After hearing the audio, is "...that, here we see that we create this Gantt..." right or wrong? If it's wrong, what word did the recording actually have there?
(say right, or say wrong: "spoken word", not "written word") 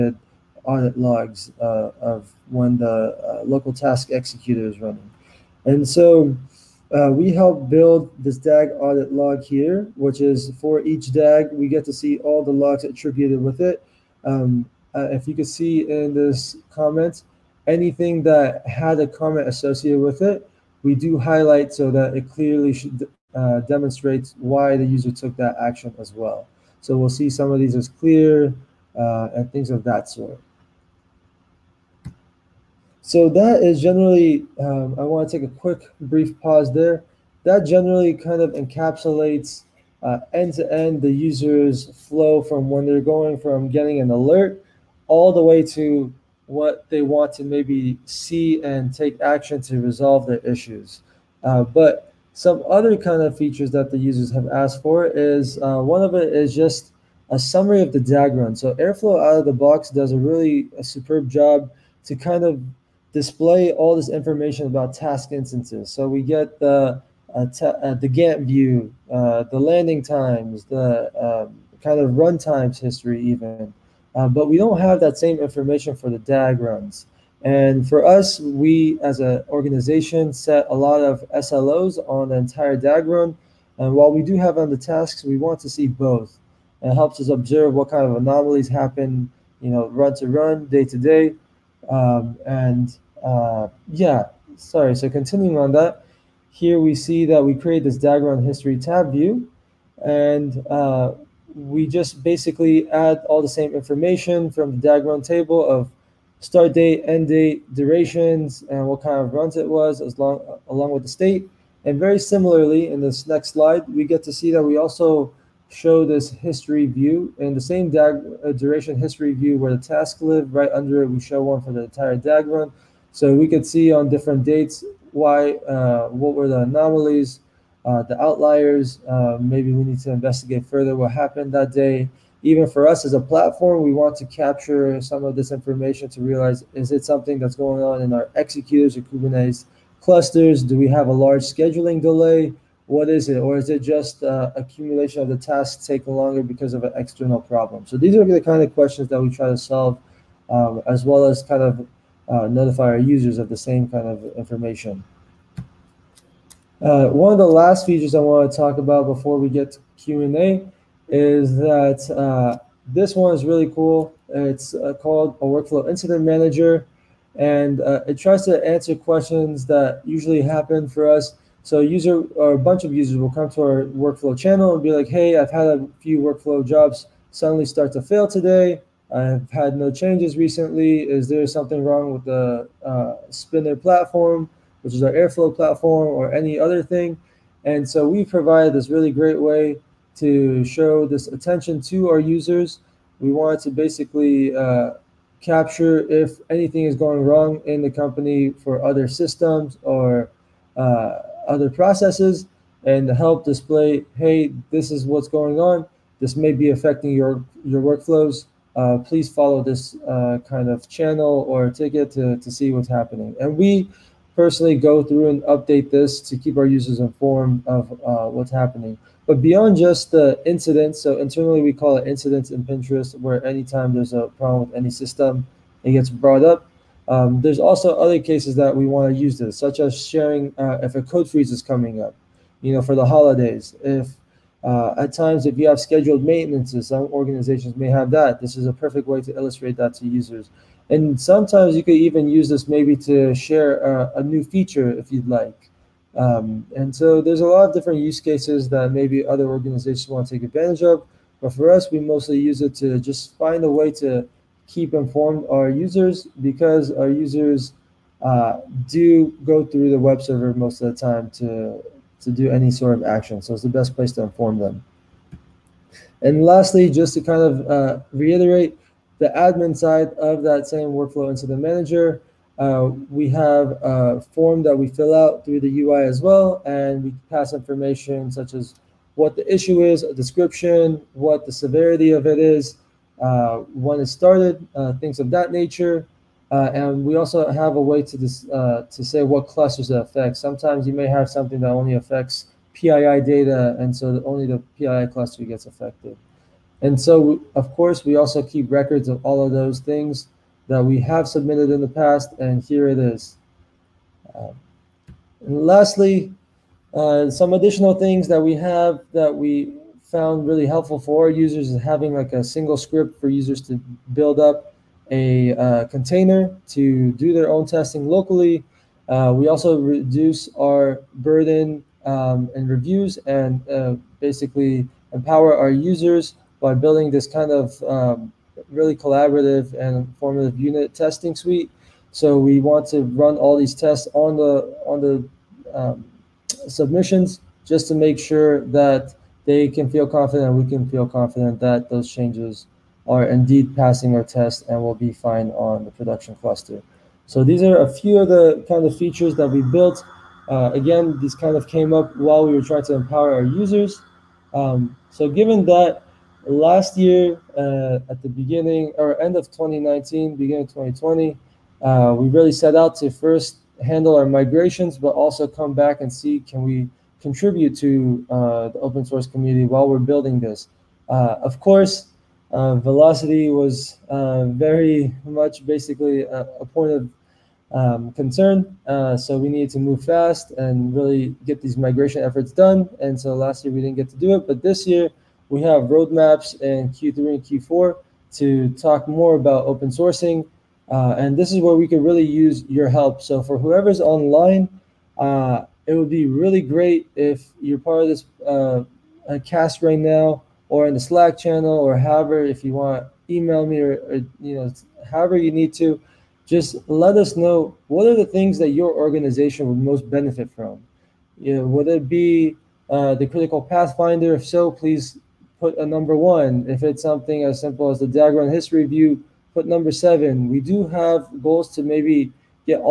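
wrong: "DAG", not "Gantt".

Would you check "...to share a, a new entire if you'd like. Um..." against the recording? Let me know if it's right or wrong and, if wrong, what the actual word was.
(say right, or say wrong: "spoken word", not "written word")
wrong: "feature", not "entire".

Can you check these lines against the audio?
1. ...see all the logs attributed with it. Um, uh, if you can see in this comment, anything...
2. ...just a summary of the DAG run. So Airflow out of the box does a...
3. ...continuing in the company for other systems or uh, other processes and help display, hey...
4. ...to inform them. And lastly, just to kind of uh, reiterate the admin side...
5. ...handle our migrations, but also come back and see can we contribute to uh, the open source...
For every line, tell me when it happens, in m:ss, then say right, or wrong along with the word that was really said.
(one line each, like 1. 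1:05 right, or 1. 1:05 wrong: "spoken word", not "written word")
1. 0:11 right
2. 0:56 right
3. 3:17 wrong: "wrong", not "continuing"
4. 4:24 right
5. 6:03 right.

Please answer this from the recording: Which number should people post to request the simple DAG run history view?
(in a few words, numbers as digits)
7.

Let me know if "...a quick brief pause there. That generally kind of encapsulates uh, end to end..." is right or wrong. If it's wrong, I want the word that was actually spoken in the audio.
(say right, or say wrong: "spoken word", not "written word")
right.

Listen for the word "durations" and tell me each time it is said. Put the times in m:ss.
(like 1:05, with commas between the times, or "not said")
1:47, 1:58.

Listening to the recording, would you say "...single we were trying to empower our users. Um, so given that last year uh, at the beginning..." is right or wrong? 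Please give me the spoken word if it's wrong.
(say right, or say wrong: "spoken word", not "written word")
wrong: "while", not "single".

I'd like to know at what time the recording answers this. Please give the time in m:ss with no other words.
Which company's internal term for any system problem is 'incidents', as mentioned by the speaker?
3:42.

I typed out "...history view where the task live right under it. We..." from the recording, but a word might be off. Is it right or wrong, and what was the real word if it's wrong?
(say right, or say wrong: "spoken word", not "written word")
right.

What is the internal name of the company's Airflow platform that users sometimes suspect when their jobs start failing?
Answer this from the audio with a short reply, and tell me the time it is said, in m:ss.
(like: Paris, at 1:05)
Spinner, at 3:03.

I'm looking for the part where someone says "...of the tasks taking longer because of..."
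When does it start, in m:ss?
2:25.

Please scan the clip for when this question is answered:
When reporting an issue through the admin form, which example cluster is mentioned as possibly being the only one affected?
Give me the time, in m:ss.
4:54.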